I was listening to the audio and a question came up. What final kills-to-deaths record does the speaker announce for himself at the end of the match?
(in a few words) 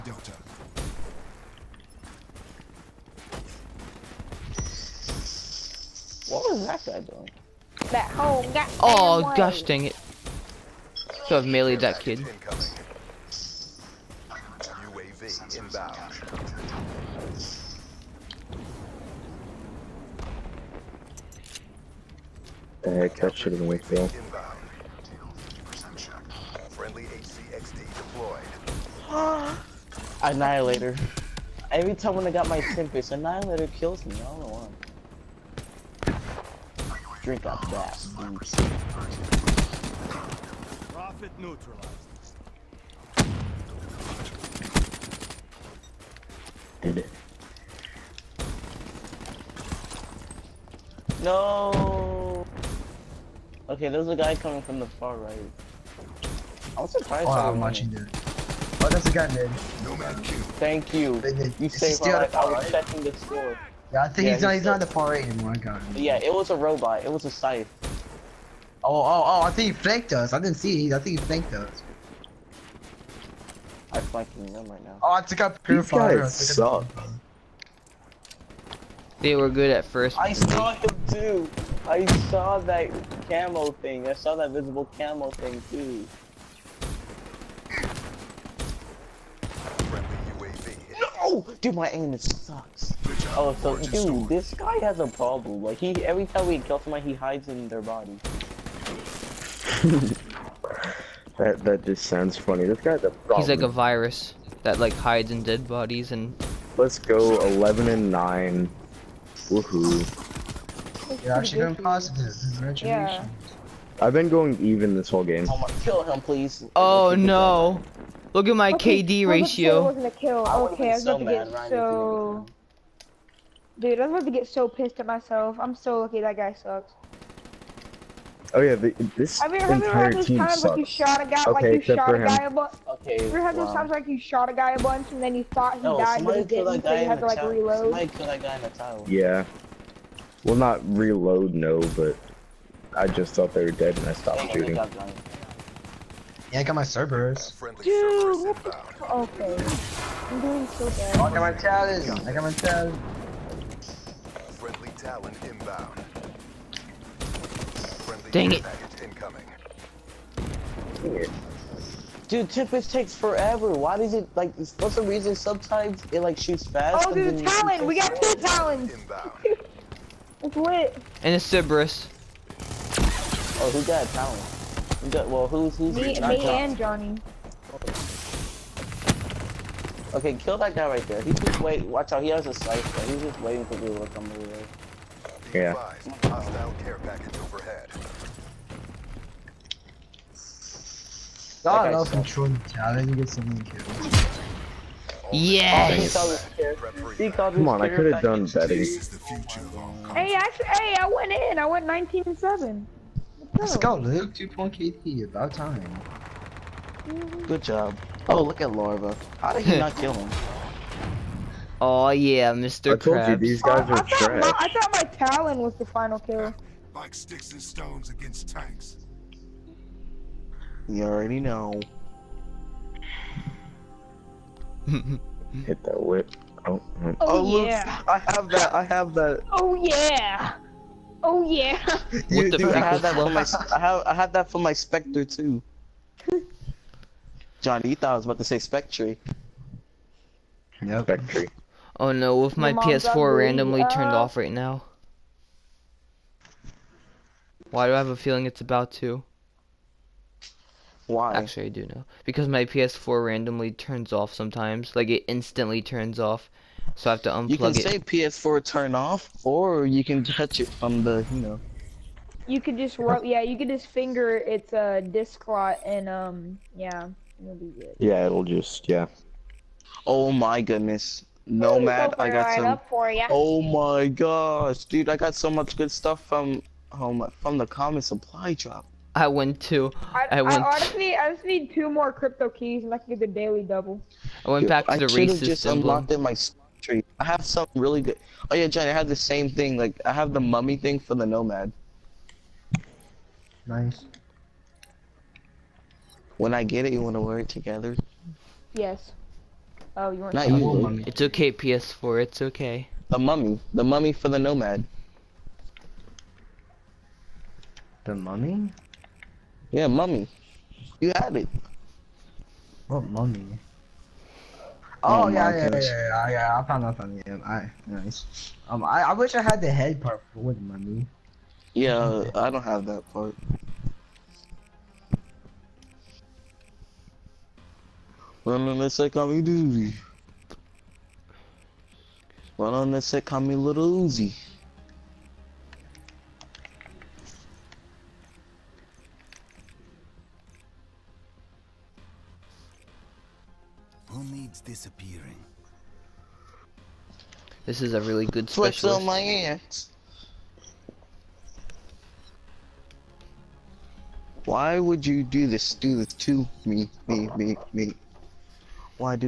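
19 and 7.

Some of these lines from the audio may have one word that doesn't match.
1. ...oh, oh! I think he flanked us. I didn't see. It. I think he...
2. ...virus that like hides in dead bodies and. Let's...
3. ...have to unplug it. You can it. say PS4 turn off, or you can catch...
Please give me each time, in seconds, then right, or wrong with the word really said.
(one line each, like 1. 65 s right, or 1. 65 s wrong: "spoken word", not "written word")
1. 69 s right
2. 103 s right
3. 257 s wrong: "touch", not "catch".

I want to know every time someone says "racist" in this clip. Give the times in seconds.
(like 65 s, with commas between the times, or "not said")
285 s.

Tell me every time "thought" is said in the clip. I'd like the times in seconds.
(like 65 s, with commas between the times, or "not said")
135 s, 143 s, 214 s, 237 s.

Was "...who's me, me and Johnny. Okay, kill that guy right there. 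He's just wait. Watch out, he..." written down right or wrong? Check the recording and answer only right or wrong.
right.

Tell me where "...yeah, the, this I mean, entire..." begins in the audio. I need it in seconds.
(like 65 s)
128 s.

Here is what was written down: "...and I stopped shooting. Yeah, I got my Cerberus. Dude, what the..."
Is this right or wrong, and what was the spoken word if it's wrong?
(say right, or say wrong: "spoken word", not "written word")
right.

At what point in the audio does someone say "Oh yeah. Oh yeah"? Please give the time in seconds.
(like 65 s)
229 s.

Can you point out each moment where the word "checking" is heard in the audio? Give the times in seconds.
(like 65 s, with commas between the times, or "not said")
62 s.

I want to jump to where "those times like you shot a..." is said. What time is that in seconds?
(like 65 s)
133 s.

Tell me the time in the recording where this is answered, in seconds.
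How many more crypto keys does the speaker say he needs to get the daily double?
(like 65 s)
281 s.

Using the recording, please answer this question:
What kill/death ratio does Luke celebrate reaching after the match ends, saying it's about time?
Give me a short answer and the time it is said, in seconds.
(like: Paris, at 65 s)
2.8, at 204 s.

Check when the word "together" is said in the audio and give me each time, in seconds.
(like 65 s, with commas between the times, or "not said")
297 s.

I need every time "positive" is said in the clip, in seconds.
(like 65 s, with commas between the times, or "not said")
111 s.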